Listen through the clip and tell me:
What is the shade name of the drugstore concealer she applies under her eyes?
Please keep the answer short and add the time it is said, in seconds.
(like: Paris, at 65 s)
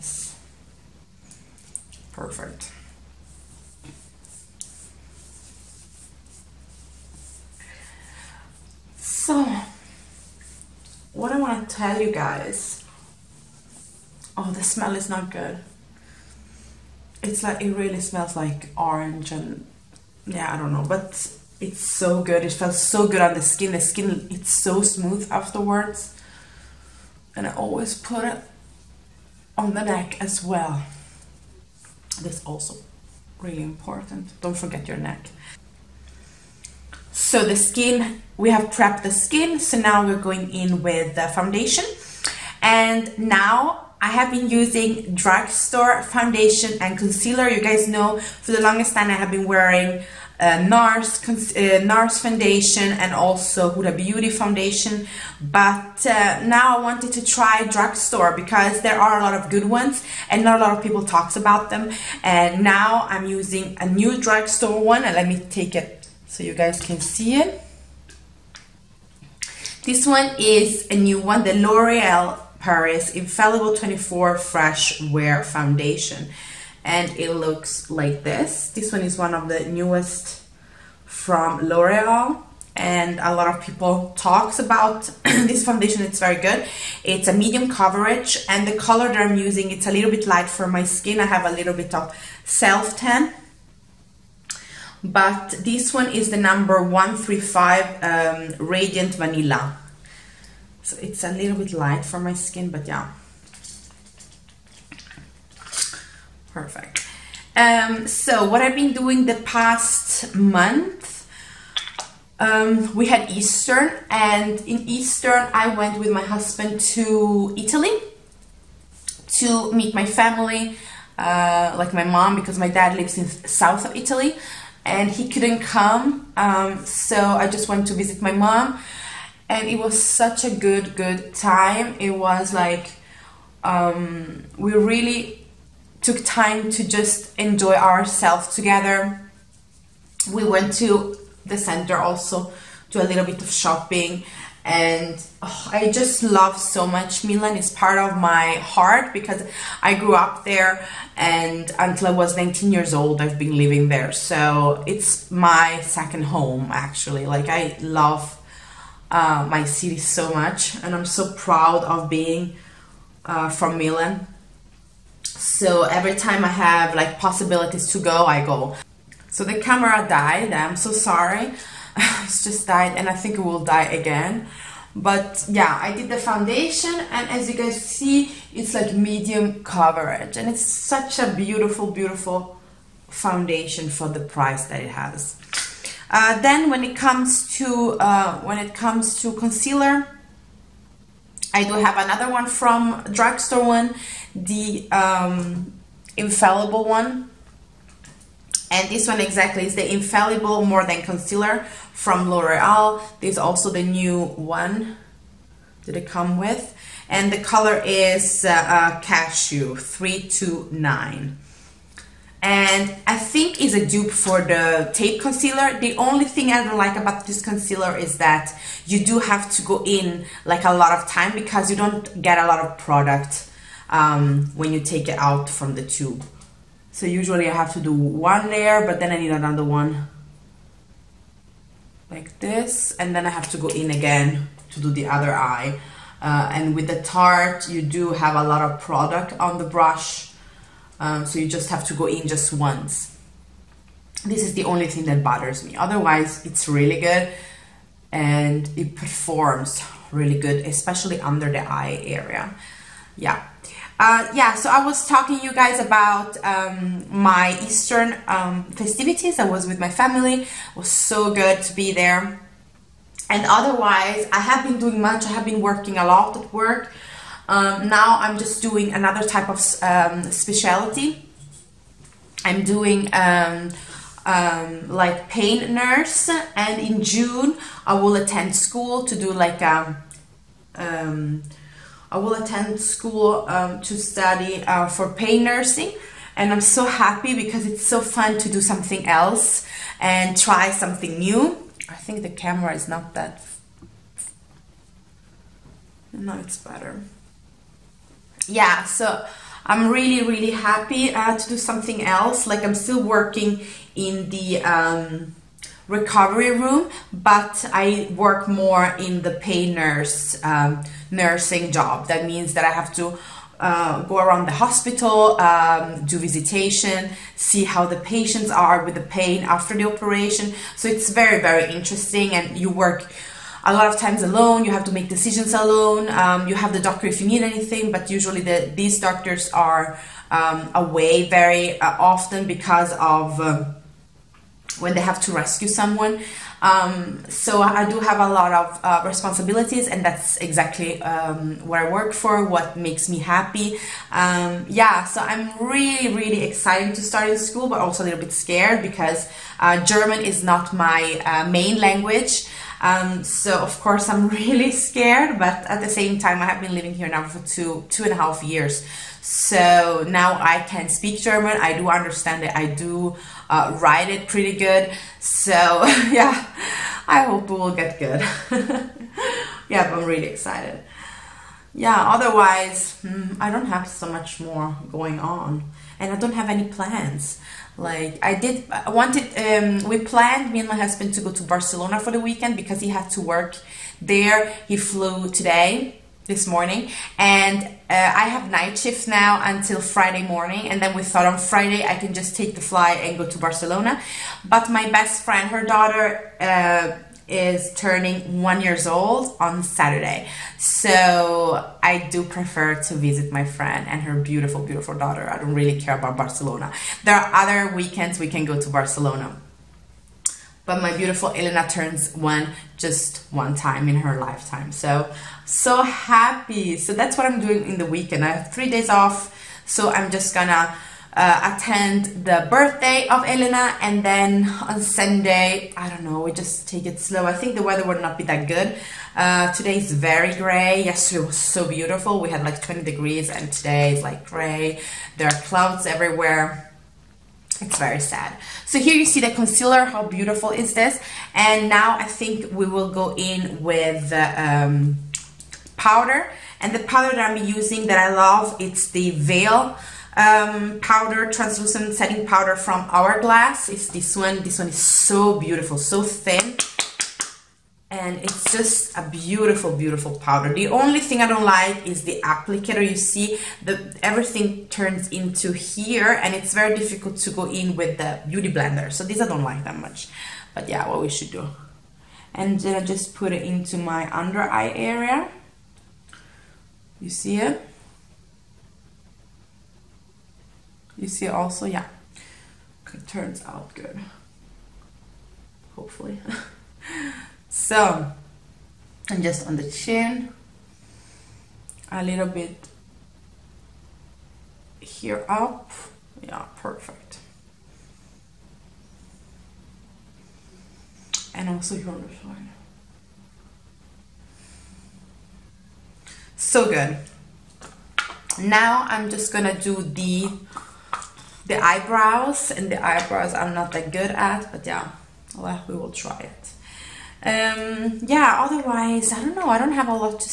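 Cashew 329, at 209 s.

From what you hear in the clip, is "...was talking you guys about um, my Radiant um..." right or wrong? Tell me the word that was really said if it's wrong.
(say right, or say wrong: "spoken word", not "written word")
wrong: "Eastern", not "Radiant".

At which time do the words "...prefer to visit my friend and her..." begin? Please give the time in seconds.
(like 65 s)
402 s.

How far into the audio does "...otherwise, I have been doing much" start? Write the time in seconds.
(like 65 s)
263 s.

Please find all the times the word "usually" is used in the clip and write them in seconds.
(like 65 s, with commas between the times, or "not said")
227 s, 328 s.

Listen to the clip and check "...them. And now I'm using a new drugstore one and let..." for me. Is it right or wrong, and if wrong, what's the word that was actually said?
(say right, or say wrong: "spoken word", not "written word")
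right.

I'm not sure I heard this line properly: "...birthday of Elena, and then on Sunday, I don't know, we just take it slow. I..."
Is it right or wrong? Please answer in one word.
right.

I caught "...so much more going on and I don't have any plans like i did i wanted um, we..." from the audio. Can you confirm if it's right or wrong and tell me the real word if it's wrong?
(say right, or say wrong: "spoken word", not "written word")
right.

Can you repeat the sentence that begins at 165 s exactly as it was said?
So every time I have like possibilities to go, I go.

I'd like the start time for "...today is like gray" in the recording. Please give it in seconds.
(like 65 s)
433 s.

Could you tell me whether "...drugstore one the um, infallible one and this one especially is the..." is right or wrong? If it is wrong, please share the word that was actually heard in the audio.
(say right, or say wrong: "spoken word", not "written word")
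wrong: "exactly", not "especially".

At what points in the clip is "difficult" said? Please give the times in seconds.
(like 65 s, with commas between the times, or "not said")
466 s.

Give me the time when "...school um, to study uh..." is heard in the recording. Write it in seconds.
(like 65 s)
282 s.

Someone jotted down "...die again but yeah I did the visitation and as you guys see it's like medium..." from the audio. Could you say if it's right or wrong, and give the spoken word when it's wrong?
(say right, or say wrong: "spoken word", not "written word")
wrong: "foundation", not "visitation".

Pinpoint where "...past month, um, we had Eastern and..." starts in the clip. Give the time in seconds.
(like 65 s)
109 s.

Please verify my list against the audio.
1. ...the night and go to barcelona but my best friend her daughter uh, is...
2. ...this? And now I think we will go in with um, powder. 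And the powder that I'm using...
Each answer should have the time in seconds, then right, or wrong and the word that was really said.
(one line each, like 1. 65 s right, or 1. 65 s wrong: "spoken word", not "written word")
1. 392 s wrong: "flight", not "night"
2. 440 s right.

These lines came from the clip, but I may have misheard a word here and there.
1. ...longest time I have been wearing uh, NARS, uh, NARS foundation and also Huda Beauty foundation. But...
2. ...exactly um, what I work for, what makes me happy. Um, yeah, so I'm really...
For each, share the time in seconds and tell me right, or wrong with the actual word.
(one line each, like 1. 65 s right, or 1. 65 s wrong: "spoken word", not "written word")
1. 48 s right
2. 340 s right.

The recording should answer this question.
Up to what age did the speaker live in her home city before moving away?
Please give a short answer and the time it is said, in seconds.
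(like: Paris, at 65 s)
19, at 152 s.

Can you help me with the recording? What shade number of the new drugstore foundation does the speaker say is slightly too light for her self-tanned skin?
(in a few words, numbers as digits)
135.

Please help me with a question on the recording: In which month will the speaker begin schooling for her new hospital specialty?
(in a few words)
June.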